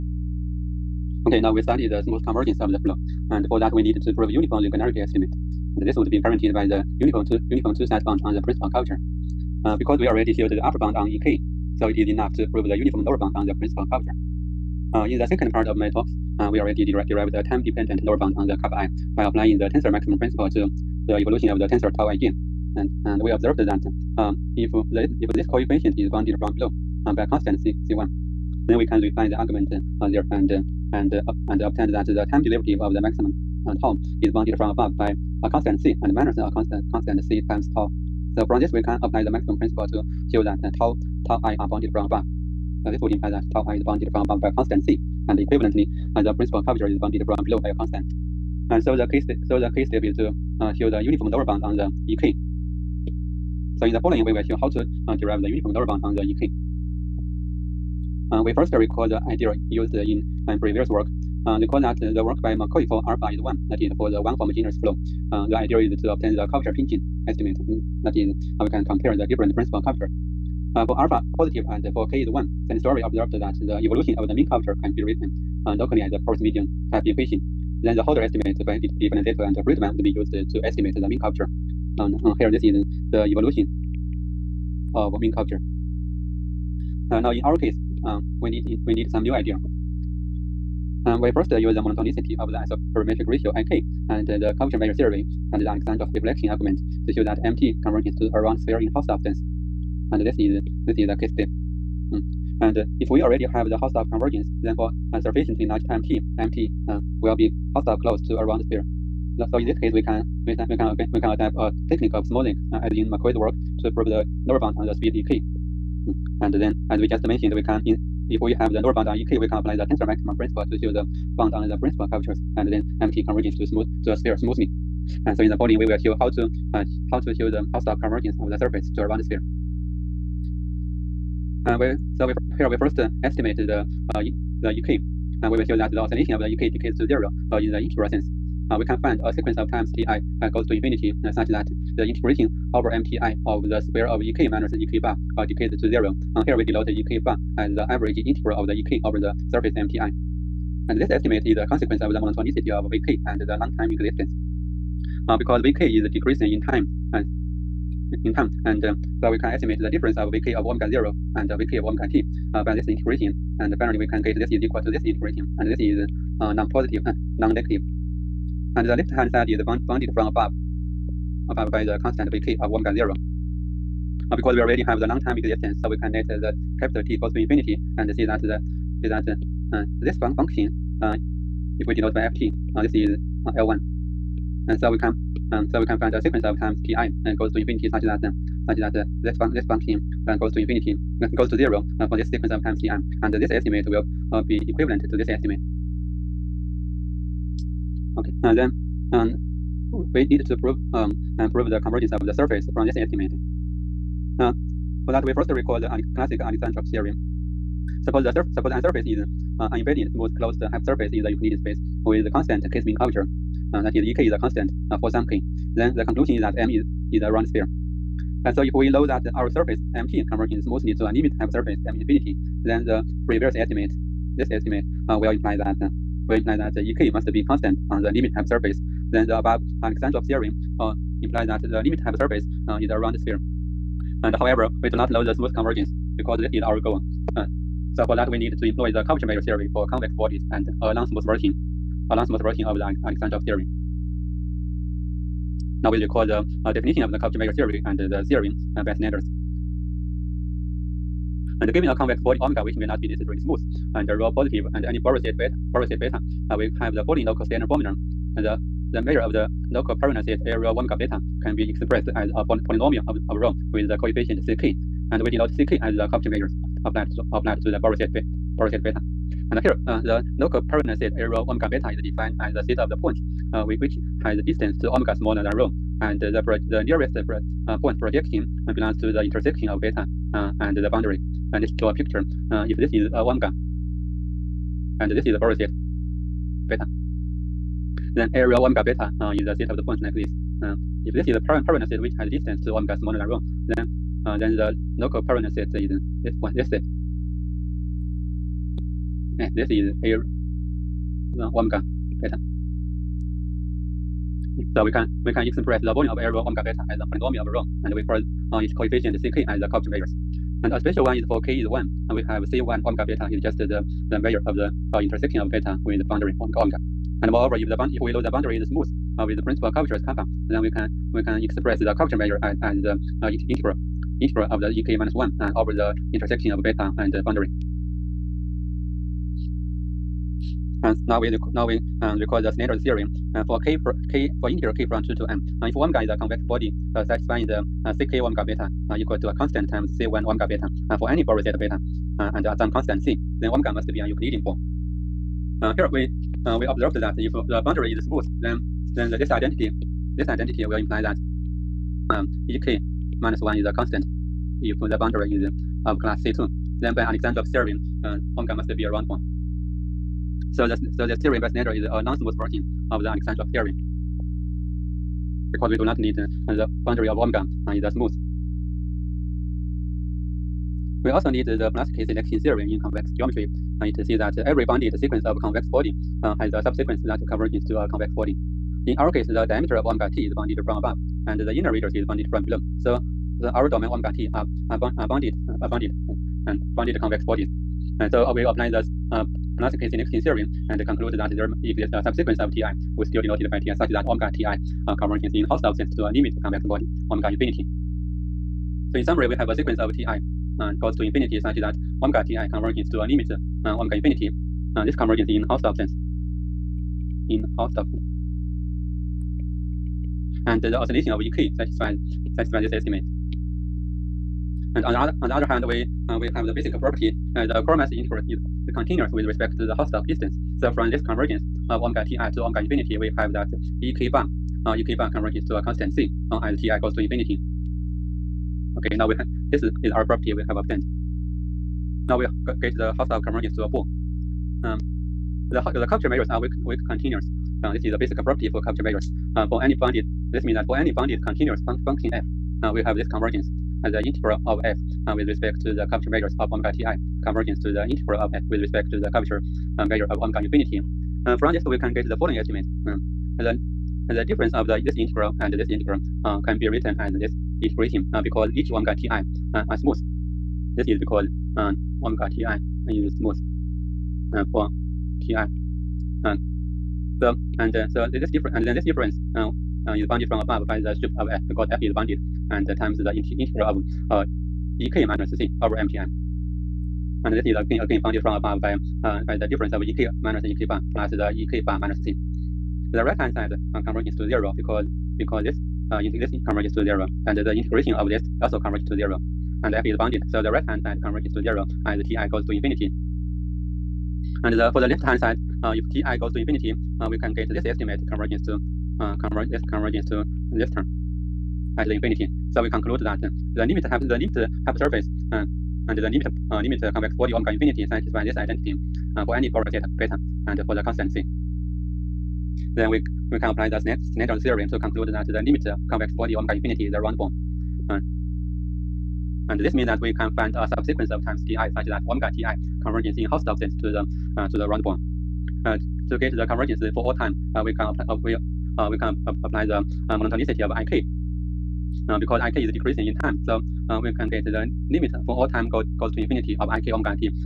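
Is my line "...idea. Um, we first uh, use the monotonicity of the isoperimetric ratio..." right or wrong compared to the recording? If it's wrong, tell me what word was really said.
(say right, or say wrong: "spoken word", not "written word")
right.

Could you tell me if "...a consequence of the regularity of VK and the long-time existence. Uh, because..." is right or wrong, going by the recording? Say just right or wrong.
wrong.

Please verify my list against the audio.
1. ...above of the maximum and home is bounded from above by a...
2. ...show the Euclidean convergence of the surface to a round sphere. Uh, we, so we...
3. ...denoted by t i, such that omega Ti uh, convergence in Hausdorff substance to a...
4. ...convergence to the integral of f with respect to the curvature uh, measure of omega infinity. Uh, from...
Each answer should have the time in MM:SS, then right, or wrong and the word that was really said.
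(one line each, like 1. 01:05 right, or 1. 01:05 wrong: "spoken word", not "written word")
1. 00:32 wrong: "derivative", not "above"
2. 02:07 wrong: "Hausdorff", not "Euclidean"
3. 06:33 right
4. 07:27 right.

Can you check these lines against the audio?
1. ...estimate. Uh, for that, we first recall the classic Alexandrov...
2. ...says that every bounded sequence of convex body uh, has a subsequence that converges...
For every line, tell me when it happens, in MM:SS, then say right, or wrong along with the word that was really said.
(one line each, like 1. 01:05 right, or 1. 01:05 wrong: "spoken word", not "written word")
1. 03:22 right
2. 06:14 right.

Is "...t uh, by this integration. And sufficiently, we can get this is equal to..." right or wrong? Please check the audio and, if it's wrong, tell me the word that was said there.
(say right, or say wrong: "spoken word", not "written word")
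wrong: "finally", not "sufficiently".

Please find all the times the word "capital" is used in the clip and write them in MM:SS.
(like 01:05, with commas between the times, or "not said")
02:56.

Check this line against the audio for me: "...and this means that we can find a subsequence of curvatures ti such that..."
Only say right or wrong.
wrong.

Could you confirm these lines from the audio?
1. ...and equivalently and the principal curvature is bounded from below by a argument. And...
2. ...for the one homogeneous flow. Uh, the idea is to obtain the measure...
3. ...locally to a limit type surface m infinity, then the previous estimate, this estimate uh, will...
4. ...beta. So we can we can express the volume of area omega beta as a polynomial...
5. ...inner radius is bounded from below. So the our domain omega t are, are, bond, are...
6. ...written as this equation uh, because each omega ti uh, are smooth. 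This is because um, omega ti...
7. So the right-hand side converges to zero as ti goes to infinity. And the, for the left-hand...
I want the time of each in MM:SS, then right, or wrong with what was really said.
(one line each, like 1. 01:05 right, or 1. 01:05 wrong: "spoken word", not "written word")
1. 00:45 wrong: "constant", not "argument"
2. 01:03 wrong: "curvature", not "measure"
3. 03:40 wrong: "smoothly", not "locally"
4. 05:02 right
5. 06:21 right
6. 07:36 wrong: "integration", not "equation"
7. 08:10 right.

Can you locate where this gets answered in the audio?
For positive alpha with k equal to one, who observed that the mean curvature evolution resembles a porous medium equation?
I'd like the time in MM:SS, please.
01:12.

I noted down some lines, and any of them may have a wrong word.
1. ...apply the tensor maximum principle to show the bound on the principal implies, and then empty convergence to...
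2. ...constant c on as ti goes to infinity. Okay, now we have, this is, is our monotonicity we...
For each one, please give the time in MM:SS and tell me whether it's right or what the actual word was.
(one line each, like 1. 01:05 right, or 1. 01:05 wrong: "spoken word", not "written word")
1. 01:59 wrong: "curvatures", not "implies"
2. 07:05 wrong: "property", not "monotonicity".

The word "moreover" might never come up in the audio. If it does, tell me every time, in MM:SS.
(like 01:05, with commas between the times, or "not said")
05:17.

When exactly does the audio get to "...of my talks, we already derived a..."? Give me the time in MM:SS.
00:15.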